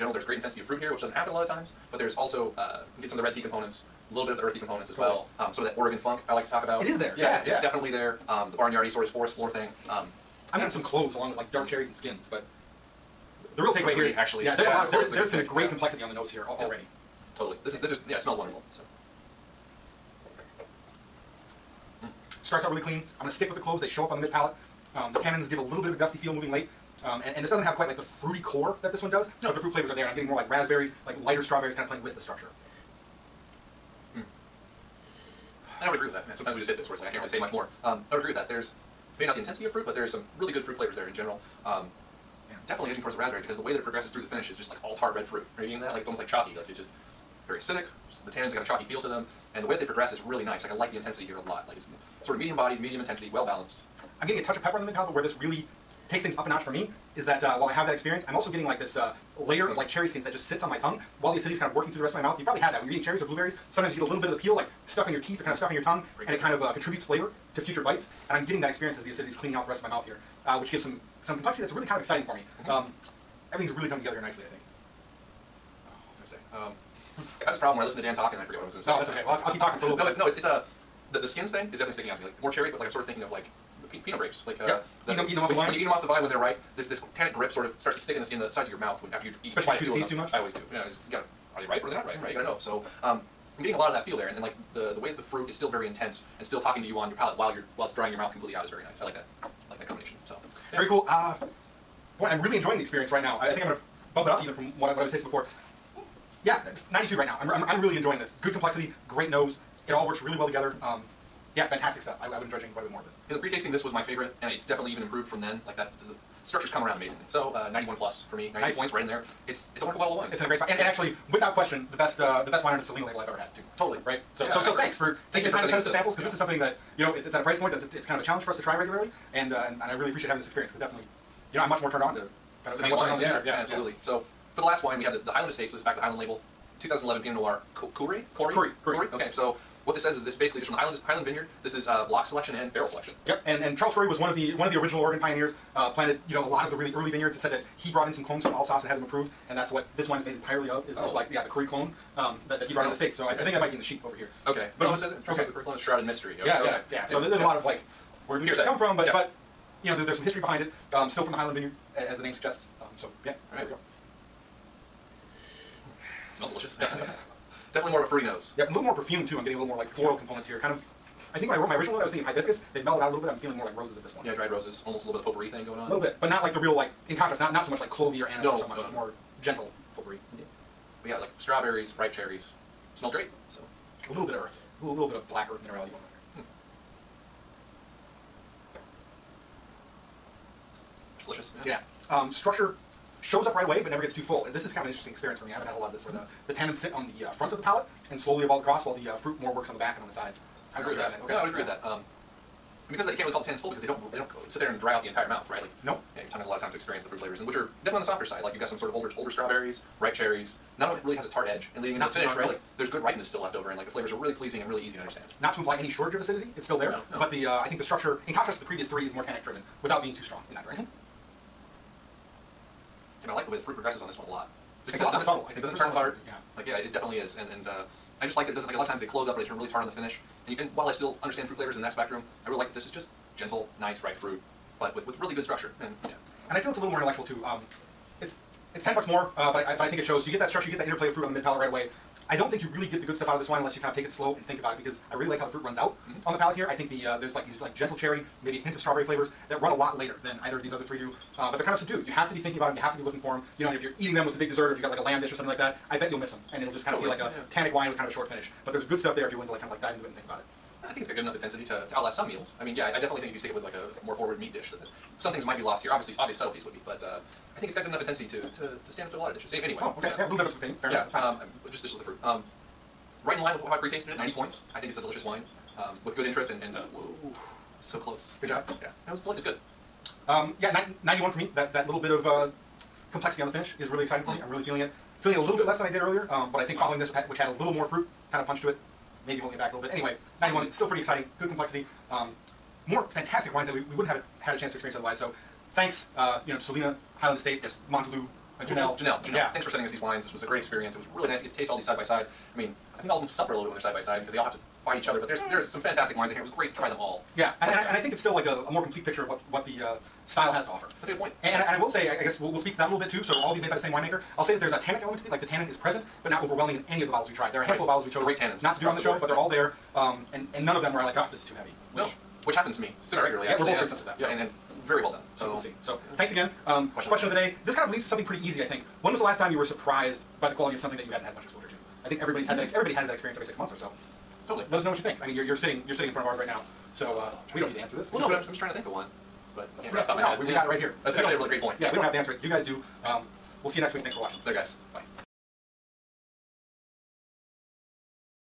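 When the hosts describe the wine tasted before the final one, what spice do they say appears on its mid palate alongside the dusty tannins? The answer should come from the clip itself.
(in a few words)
Cloves.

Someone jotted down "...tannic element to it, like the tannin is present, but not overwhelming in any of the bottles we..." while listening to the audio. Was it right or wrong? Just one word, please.
right.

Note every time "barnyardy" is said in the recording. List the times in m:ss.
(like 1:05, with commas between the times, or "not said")
0:08.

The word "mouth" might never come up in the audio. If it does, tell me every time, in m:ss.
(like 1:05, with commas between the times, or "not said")
1:02, 1:09, 1:28, 1:38, 3:25.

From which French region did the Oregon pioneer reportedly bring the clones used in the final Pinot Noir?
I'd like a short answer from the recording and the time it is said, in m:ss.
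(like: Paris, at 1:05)
Alsace, at 2:28.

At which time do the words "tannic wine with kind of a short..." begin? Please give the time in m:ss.
4:17.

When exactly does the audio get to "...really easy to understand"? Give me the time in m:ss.
3:34.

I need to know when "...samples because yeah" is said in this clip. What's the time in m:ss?
2:05.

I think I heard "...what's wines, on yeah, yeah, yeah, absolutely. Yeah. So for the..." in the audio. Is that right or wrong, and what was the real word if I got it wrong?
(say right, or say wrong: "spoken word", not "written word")
right.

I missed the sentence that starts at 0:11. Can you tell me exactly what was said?
cherries and skins, but the real takeaway here, is, actually, yeah, there's yeah, a lot of there is there's some pick.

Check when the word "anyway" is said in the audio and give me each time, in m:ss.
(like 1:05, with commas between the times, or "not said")
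4:29, 4:49.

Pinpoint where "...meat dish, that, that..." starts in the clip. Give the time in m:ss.
4:24.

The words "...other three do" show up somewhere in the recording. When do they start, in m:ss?
4:10.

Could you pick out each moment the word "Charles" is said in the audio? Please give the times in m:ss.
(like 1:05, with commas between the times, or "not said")
2:23, 2:35.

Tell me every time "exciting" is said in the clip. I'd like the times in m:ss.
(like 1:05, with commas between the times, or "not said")
1:12, 4:44, 4:51.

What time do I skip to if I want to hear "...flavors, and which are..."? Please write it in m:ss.
3:27.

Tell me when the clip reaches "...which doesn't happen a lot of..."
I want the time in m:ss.
0:00.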